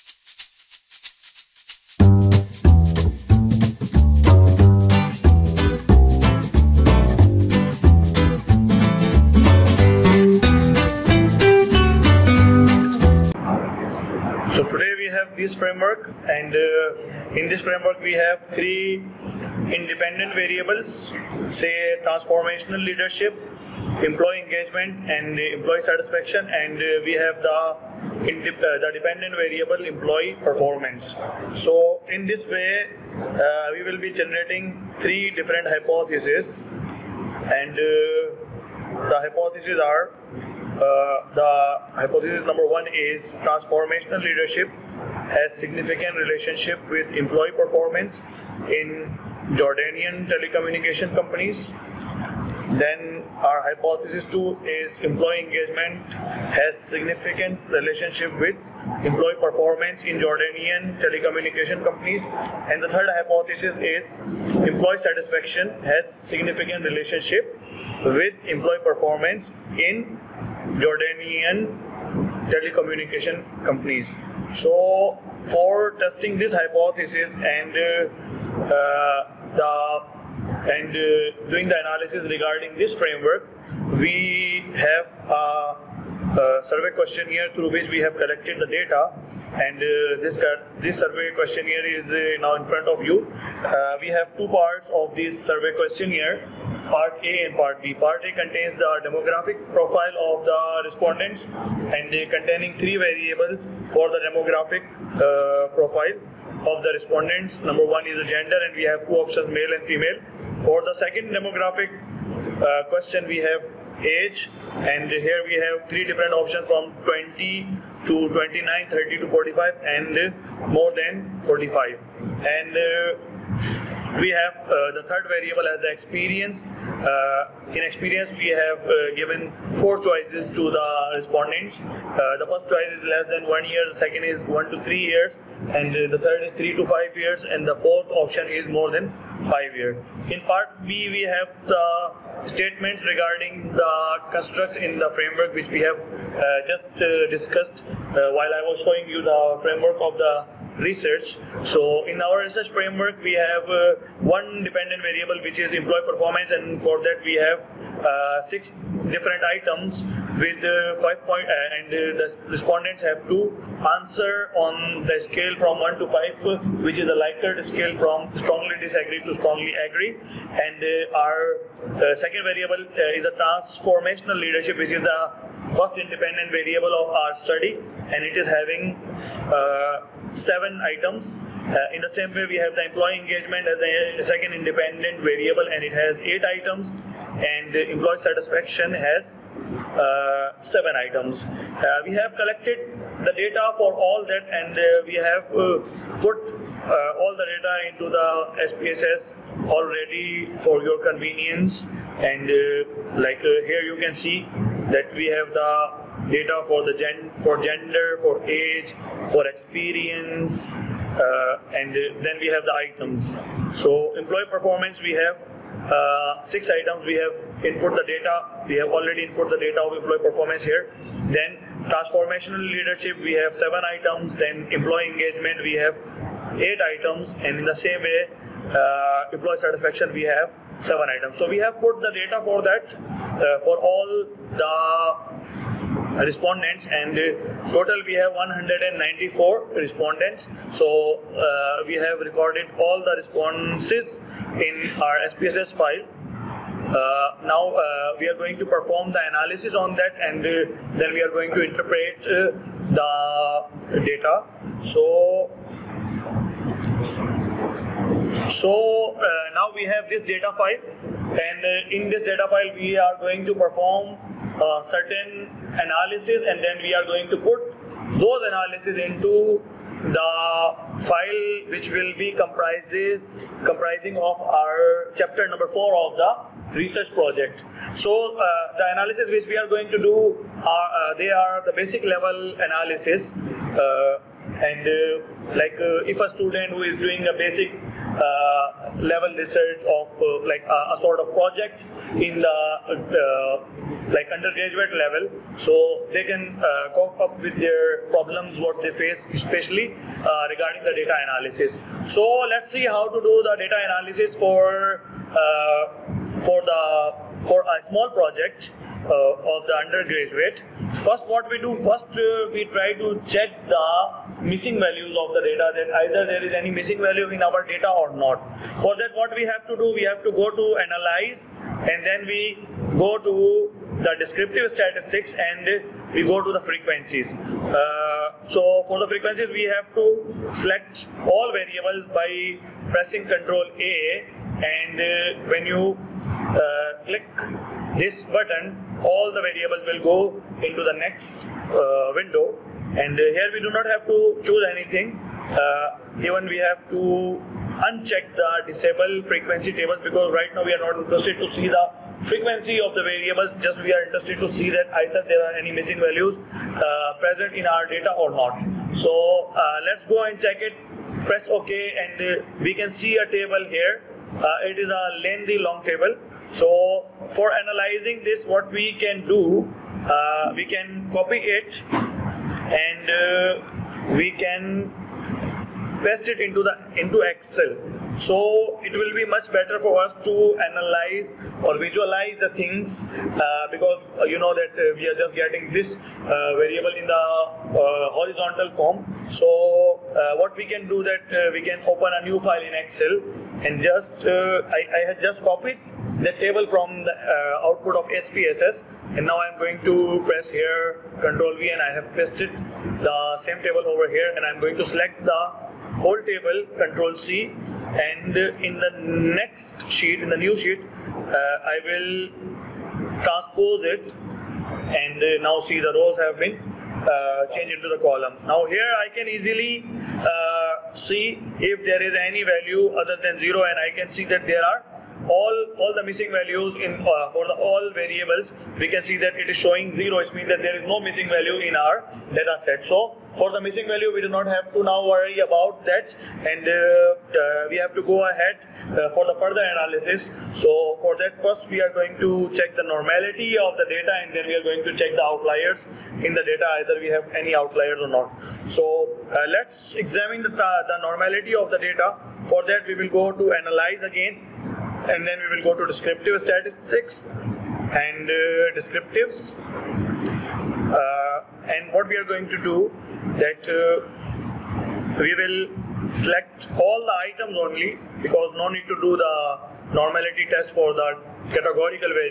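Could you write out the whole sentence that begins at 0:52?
Then our hypothesis two is employee engagement has significant relationship with employee performance in Jordanian telecommunication companies.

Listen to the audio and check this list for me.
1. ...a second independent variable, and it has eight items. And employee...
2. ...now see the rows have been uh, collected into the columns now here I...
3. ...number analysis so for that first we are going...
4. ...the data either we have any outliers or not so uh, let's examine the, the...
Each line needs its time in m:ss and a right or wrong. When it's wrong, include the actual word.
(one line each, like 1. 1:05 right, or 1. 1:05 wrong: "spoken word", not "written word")
1. 3:03 right
2. 6:55 wrong: "changed", not "collected"
3. 7:19 wrong: "further", not "number"
4. 7:26 right.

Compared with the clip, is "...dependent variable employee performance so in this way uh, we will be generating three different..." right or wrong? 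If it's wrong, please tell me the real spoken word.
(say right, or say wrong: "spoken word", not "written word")
right.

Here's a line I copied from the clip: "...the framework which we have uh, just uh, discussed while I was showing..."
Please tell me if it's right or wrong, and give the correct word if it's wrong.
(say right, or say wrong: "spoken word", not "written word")
right.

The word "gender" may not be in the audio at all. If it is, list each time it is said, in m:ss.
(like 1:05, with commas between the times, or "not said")
1:48, 3:27.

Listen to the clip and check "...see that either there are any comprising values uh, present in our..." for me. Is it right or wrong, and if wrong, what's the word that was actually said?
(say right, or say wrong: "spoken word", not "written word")
wrong: "missing", not "comprising".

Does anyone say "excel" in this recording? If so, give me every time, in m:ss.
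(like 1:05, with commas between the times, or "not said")
6:17, 6:32.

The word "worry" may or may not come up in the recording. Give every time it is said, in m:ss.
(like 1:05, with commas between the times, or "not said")
7:15.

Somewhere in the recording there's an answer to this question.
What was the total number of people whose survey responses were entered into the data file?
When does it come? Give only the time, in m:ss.
3:58.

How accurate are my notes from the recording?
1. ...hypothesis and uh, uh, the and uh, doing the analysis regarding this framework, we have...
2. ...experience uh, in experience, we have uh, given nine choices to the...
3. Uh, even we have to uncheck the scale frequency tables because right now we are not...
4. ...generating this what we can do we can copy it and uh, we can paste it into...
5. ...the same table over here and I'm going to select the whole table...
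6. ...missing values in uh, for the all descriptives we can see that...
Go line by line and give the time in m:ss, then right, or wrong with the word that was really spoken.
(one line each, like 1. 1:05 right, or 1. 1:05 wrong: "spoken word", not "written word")
1. 1:16 right
2. 2:05 wrong: "four", not "nine"
3. 5:45 wrong: "disable", not "scale"
4. 6:07 wrong: "analyzing", not "generating"
5. 6:43 right
6. 7:06 wrong: "variables", not "descriptives".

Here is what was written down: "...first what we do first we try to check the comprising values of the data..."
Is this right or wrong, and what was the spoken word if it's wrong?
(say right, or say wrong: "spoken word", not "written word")
wrong: "missing", not "comprising".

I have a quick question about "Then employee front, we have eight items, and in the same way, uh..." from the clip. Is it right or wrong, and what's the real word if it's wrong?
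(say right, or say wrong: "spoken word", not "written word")
wrong: "engagement", not "front".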